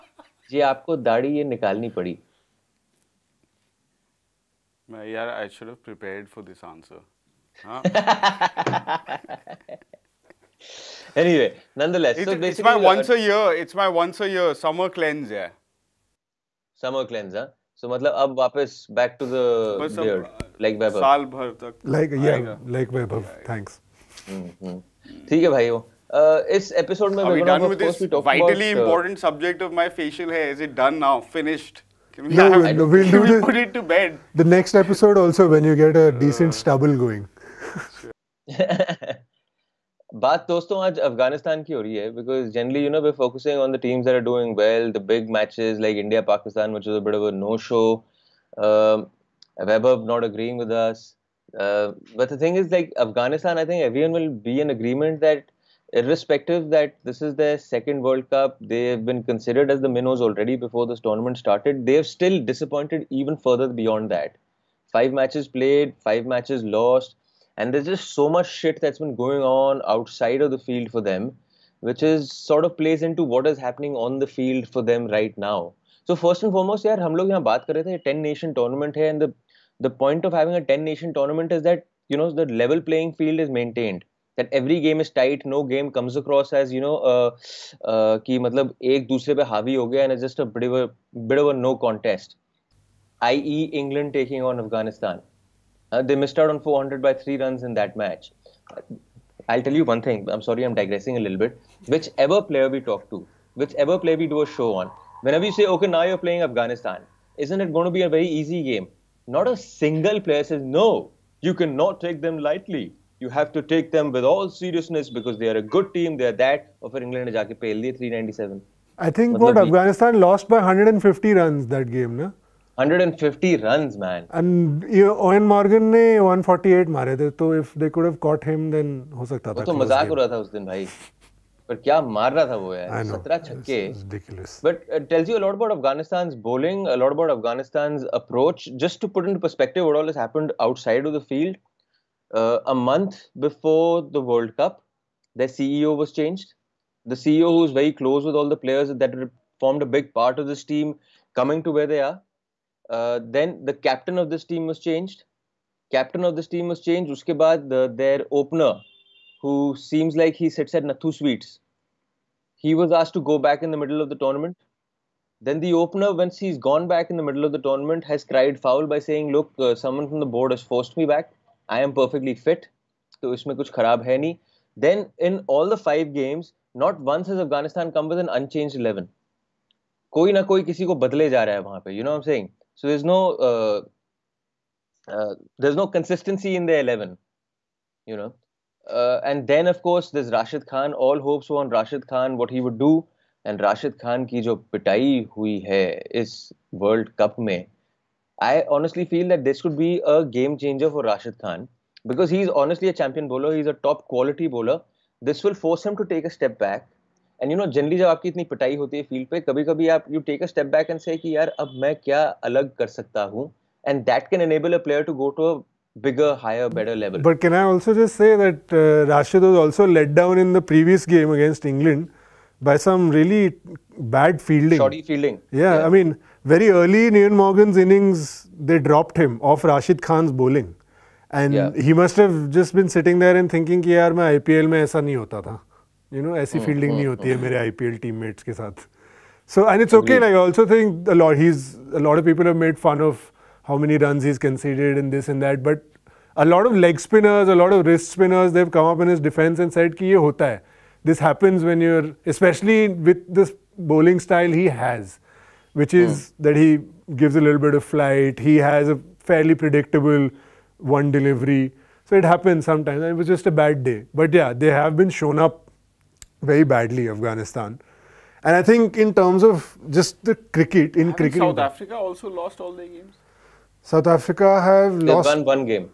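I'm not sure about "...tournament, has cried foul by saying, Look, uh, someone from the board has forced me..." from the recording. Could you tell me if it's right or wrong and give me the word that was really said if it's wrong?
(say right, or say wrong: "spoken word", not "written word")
right.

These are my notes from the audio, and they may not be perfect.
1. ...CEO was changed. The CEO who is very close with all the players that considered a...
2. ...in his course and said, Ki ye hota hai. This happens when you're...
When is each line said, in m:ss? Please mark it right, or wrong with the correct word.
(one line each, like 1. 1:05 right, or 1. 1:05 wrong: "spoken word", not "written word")
1. 2:25 wrong: "formed", not "considered"
2. 4:08 wrong: "defense", not "course".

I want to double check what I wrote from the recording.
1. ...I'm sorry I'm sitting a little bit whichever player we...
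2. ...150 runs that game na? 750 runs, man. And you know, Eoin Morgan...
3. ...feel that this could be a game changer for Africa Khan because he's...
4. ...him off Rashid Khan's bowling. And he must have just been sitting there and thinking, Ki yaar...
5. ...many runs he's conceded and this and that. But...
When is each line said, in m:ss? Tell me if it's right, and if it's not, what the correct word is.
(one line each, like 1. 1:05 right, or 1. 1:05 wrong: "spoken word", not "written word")
1. 1:40 wrong: "digressing", not "sitting"
2. 2:00 wrong: "150", not "750"
3. 3:19 wrong: "Rashid", not "Africa"
4. 3:49 right
5. 4:03 right.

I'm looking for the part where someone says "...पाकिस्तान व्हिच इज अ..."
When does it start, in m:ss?
0:46.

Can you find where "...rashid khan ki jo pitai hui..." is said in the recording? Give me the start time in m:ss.
3:13.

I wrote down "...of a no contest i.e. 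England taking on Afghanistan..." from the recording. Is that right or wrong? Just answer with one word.
right.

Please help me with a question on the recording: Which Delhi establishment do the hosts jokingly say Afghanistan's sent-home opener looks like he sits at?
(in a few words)
Nathu Sweets.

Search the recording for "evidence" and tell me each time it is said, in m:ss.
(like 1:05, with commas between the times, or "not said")
not said.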